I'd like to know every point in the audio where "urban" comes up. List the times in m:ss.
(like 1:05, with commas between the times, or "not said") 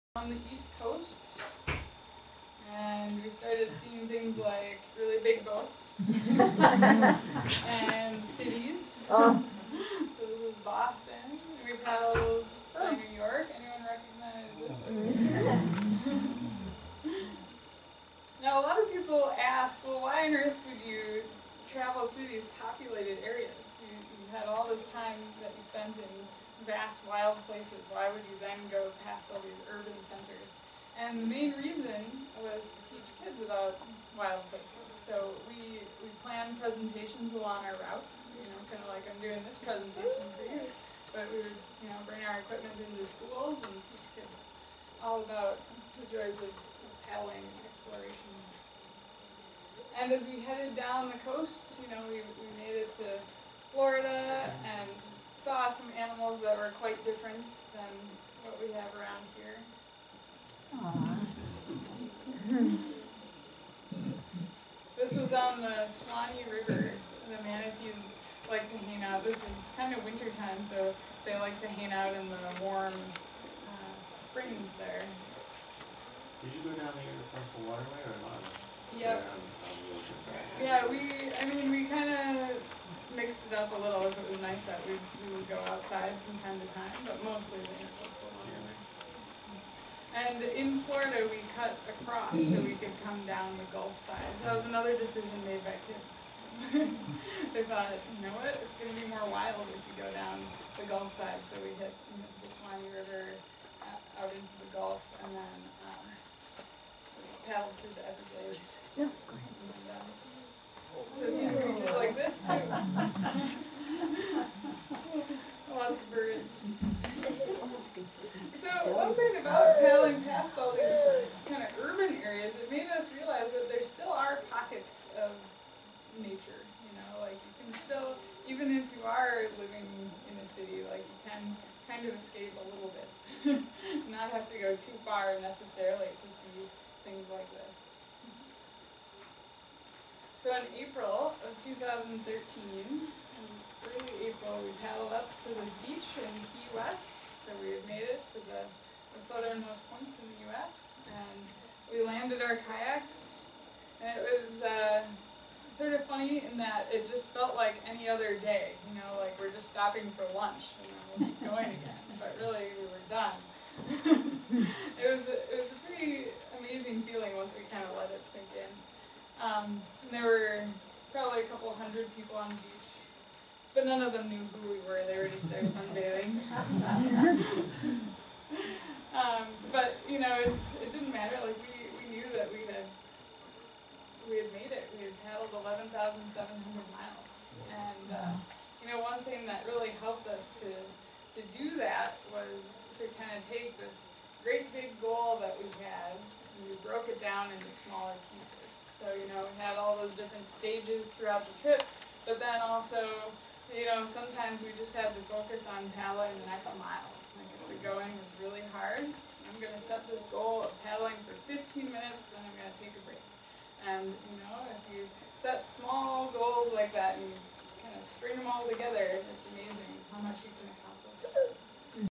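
0:29, 2:01.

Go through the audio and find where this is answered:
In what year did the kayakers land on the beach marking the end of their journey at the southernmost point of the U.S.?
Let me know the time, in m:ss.
2:21.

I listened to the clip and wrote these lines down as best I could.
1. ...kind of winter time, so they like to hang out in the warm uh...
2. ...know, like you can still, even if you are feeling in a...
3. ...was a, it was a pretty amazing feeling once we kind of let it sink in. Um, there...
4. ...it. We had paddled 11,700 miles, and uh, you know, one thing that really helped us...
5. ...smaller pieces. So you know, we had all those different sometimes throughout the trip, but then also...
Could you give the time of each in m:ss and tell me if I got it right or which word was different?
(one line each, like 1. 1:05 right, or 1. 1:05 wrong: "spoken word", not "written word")
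1. 1:09 right
2. 2:07 wrong: "living", not "feeling"
3. 2:45 right
4. 3:04 right
5. 3:17 wrong: "stages", not "sometimes".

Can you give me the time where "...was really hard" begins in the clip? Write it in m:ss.
3:28.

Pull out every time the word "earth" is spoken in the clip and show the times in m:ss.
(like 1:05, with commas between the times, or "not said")
0:20.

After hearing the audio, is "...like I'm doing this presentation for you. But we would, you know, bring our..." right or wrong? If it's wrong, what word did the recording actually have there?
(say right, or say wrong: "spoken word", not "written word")
right.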